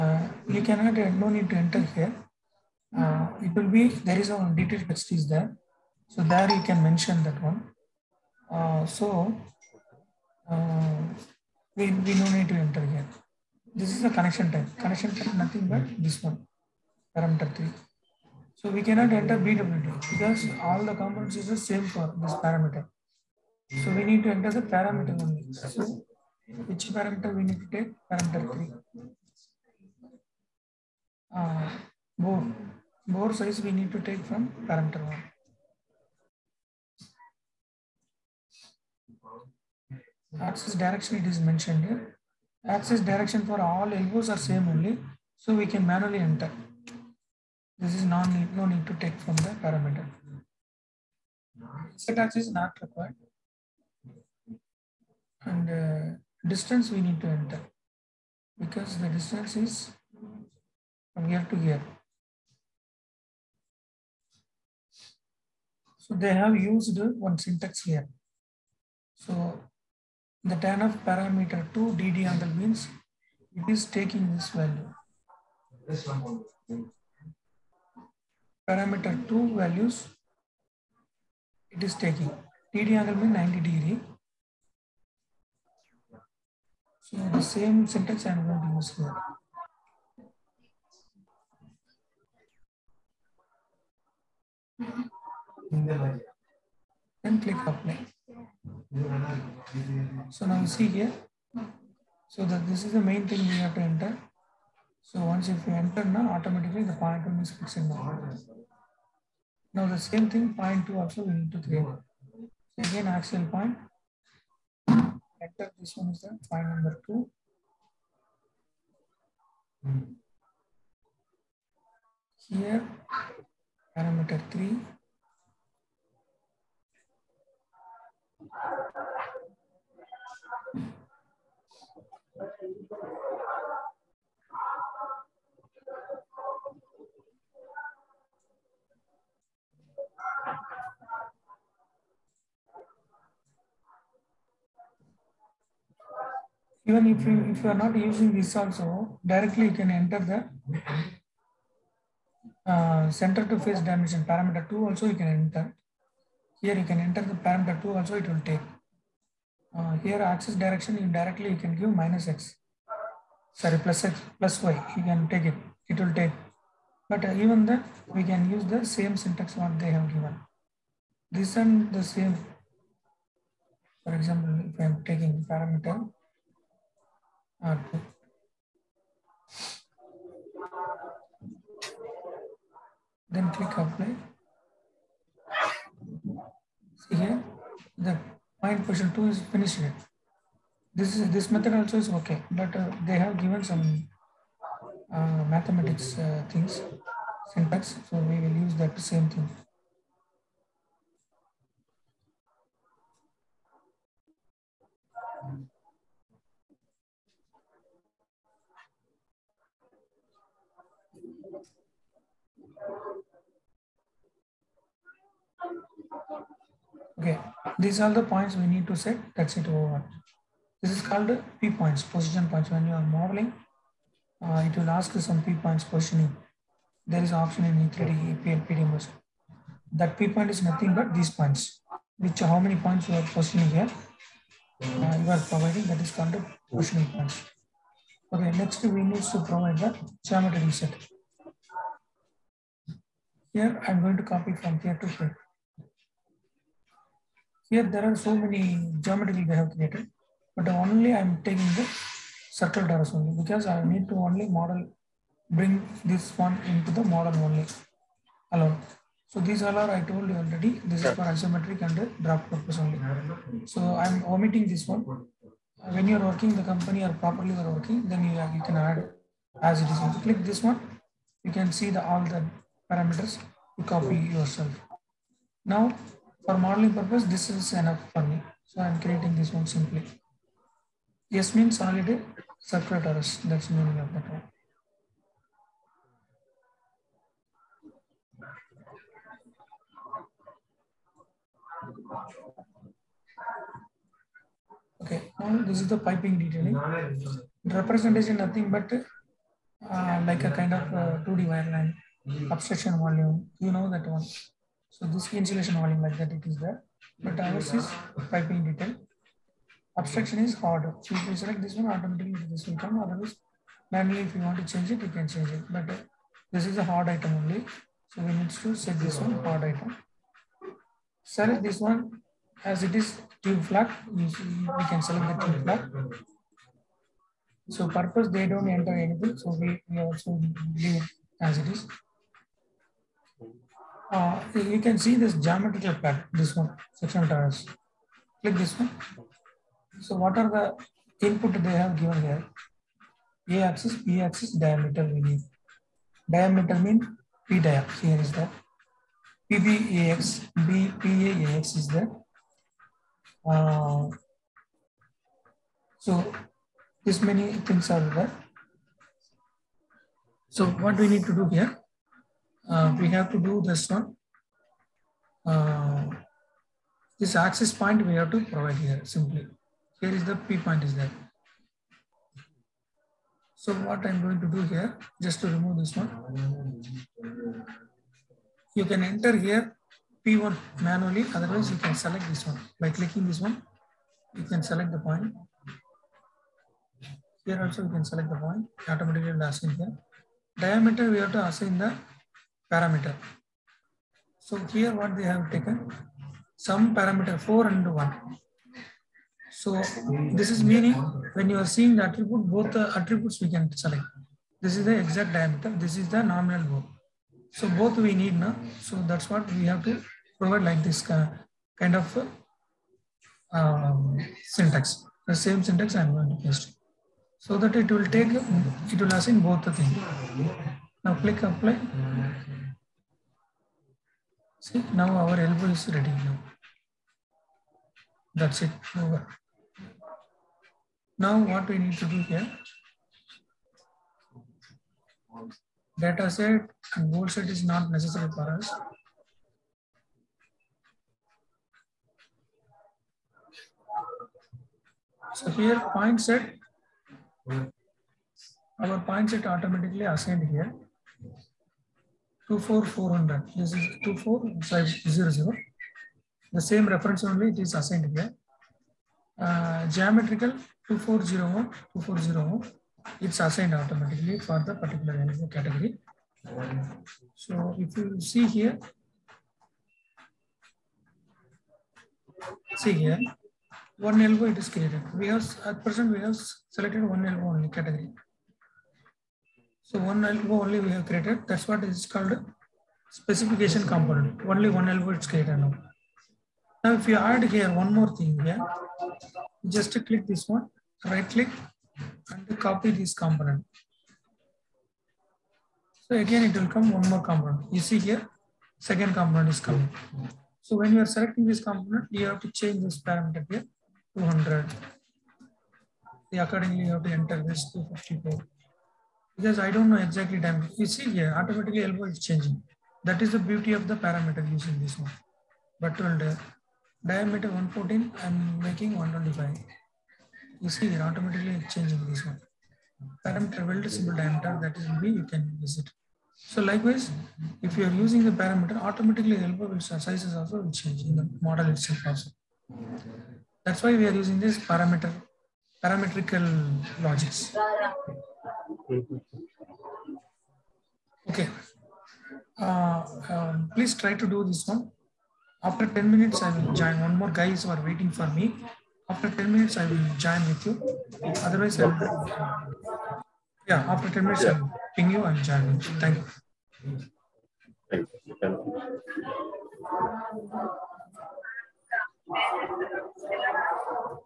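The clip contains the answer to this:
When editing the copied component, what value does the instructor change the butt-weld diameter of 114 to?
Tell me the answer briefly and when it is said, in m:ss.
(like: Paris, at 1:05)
125, at 8:38.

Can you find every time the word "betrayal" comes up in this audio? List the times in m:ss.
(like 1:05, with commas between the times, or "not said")
not said.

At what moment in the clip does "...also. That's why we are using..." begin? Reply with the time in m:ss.
8:52.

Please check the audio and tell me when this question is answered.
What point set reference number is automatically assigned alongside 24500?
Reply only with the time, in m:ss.
7:32.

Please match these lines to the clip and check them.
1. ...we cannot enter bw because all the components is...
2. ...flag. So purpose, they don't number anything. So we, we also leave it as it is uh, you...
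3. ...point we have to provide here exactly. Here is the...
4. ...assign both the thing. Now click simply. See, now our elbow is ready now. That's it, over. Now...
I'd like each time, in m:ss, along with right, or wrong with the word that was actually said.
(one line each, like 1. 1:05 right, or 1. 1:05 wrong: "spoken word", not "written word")
1. 0:18 right
2. 5:25 wrong: "enter", not "number"
3. 6:07 wrong: "simply", not "exactly"
4. 6:59 wrong: "apply", not "simply".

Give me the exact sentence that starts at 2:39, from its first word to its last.
Uh, here axis direction you directly you can give minus x.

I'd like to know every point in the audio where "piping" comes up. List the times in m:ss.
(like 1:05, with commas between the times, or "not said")
4:55, 5:08.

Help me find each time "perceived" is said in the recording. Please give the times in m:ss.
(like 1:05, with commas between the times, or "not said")
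not said.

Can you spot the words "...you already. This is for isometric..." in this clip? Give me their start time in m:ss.
4:20.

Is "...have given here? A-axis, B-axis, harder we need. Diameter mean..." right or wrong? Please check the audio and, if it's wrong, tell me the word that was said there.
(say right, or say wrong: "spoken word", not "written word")
wrong: "diameter", not "harder".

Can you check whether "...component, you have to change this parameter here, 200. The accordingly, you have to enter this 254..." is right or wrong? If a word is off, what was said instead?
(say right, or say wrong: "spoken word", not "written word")
right.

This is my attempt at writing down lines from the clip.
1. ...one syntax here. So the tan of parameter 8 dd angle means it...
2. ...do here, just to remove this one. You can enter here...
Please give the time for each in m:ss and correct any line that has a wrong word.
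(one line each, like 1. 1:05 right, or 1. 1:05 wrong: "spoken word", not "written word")
1. 1:07 wrong: "2", not "8"
2. 6:14 right.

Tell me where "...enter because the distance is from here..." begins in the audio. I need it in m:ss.
0:57.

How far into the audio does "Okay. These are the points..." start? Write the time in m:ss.
3:37.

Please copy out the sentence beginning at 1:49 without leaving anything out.
Now the same thing, point two also we need to create.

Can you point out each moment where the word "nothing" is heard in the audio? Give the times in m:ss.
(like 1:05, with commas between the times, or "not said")
0:15, 3:50, 4:58.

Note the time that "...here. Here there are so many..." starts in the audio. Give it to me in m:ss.
4:05.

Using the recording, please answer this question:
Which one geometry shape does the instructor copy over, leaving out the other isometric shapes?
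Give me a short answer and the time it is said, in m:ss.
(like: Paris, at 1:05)
Circle torus, at 4:12.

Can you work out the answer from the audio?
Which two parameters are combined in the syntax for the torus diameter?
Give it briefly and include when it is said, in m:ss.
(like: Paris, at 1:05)
4 and 1, at 6:36.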